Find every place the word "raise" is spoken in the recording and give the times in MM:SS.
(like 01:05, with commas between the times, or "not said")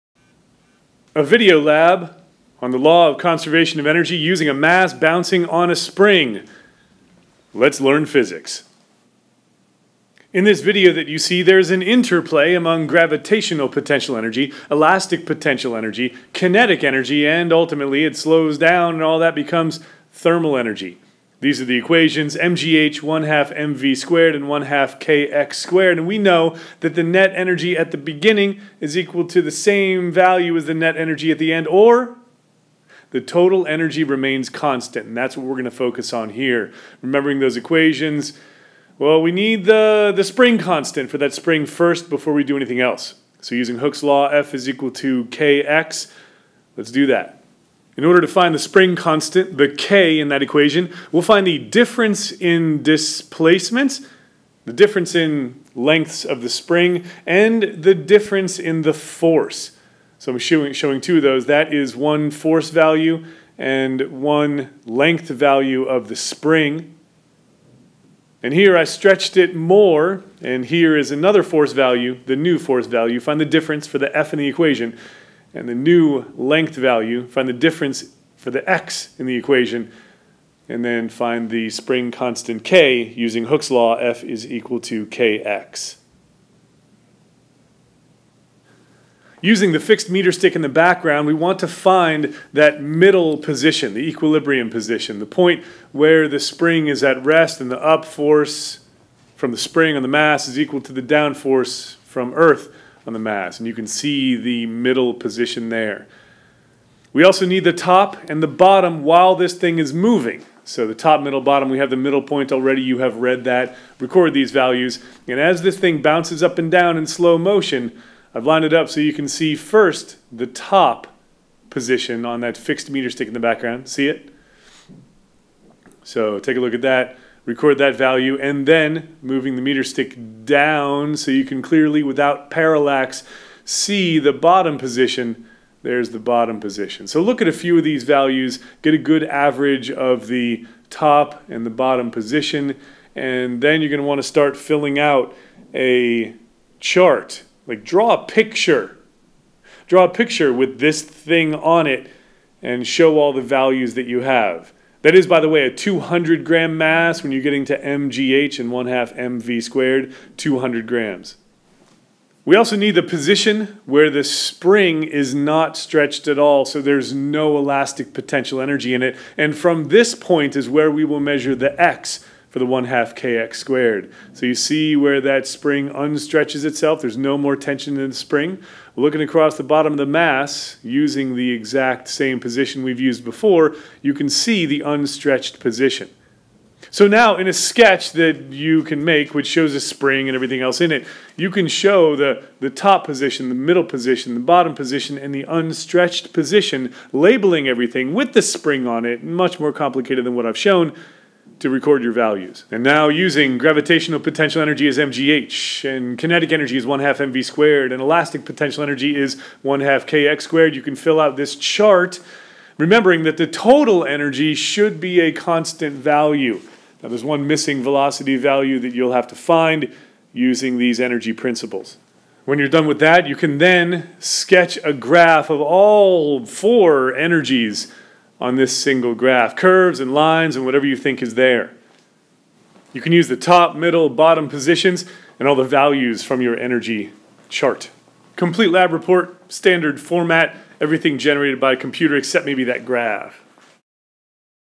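not said.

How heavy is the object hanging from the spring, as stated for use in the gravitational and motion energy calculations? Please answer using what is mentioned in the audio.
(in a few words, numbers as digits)
200 grams.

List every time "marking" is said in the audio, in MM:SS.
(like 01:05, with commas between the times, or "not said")
not said.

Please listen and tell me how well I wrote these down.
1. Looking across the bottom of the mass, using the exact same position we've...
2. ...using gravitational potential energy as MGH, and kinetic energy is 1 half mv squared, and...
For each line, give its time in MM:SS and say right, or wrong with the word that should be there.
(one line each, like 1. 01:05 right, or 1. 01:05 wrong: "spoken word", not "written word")
1. 02:58 right
2. 03:23 right.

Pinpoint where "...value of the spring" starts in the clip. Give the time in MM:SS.
01:05.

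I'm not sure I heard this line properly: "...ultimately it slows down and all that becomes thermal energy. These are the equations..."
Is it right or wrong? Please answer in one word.
right.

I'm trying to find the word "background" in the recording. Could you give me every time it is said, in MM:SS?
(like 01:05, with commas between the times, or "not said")
01:30, 02:03.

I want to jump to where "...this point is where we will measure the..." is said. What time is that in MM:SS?
02:49.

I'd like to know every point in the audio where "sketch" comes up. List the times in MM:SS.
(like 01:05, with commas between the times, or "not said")
03:07, 03:44.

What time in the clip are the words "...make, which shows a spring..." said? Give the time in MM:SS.
03:09.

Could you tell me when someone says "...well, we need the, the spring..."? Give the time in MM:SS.
00:38.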